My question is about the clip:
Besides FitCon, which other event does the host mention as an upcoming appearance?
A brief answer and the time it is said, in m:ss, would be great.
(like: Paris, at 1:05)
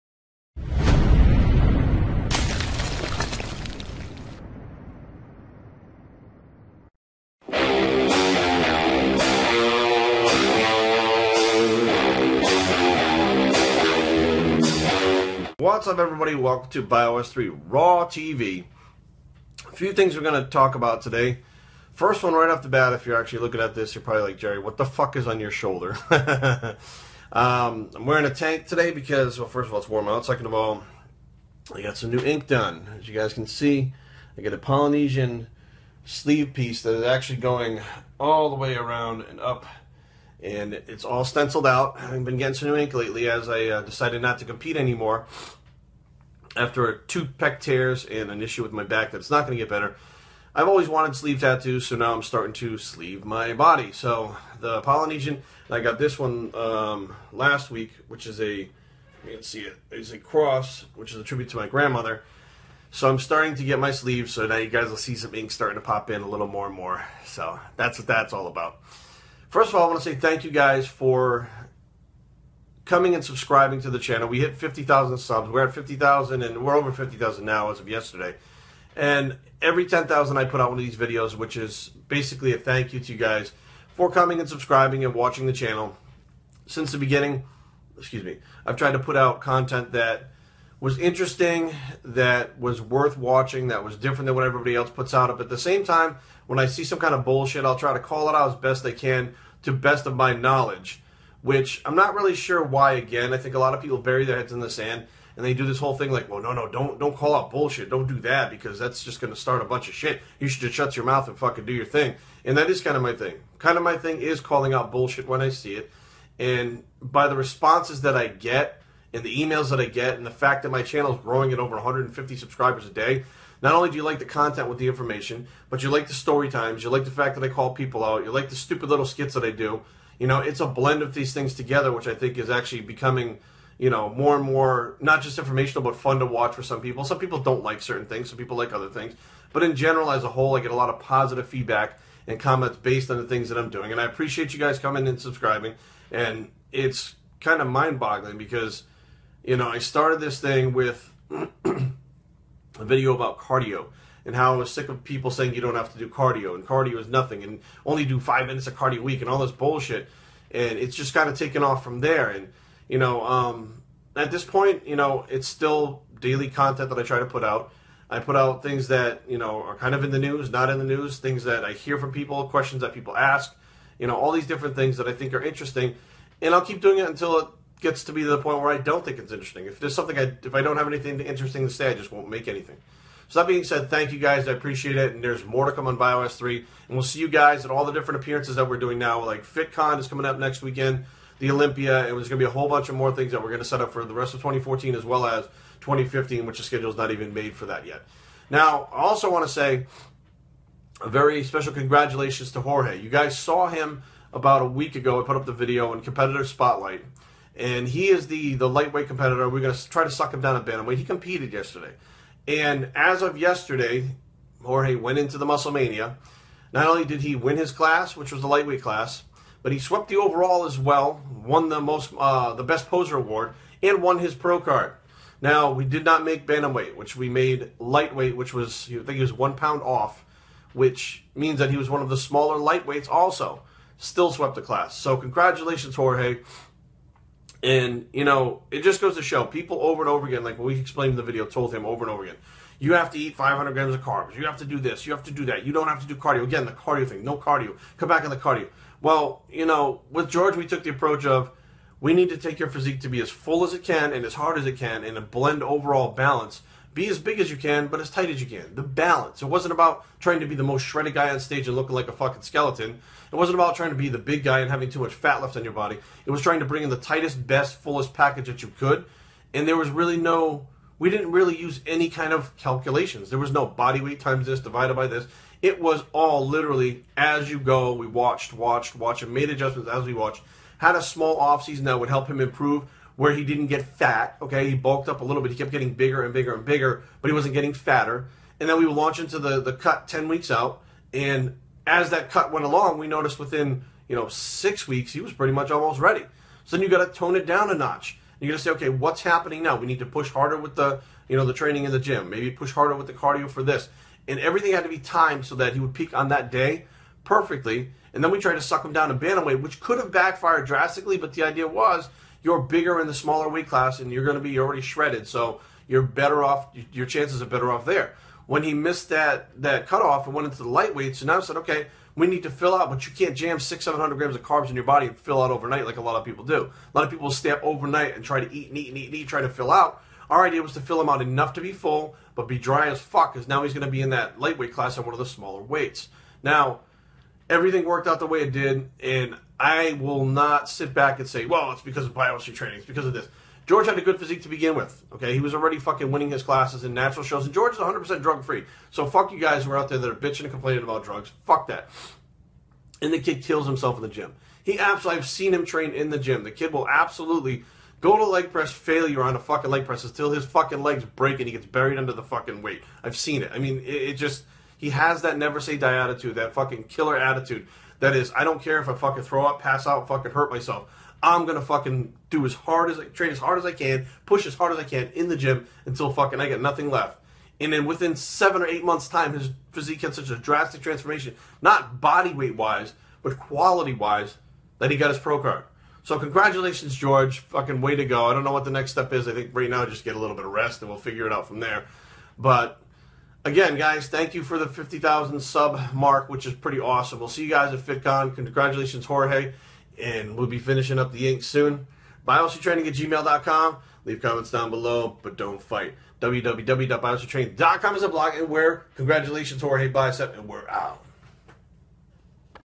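the Olympia, at 3:11.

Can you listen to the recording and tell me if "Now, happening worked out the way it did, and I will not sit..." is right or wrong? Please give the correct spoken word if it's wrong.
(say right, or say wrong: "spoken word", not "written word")
wrong: "everything", not "happening".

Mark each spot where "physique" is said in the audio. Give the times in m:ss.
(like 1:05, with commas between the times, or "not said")
4:12, 5:44, 6:19.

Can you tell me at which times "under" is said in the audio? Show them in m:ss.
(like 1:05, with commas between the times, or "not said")
6:01.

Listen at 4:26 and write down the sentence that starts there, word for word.
It was trying to bring in the tightest, best, fullest package that you could.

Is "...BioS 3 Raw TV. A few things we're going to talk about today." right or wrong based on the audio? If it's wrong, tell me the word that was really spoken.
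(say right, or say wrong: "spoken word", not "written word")
right.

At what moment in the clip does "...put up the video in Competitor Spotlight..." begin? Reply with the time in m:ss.
3:25.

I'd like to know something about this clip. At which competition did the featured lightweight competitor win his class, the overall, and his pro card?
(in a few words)
Musclemania.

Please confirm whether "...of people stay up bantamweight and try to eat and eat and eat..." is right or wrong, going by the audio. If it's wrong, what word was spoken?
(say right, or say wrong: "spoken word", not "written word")
wrong: "overnight", not "bantamweight".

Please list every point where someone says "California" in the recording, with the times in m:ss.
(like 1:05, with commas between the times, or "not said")
not said.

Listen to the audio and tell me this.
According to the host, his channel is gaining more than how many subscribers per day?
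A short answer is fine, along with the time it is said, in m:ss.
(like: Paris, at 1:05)
150, at 2:01.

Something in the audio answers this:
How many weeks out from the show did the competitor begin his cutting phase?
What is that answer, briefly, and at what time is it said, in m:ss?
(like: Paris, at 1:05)
10, at 4:50.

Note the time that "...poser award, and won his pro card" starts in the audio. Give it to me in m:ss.
3:42.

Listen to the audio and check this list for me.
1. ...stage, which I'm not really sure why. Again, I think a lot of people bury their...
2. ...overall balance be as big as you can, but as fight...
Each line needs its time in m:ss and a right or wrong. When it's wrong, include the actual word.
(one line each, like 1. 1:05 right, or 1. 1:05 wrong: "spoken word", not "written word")
1. 1:40 wrong: "knowledge", not "stage"
2. 4:15 wrong: "tight", not "fight".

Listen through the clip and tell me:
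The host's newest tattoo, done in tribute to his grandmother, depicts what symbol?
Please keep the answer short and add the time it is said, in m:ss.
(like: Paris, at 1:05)
cross, at 1:00.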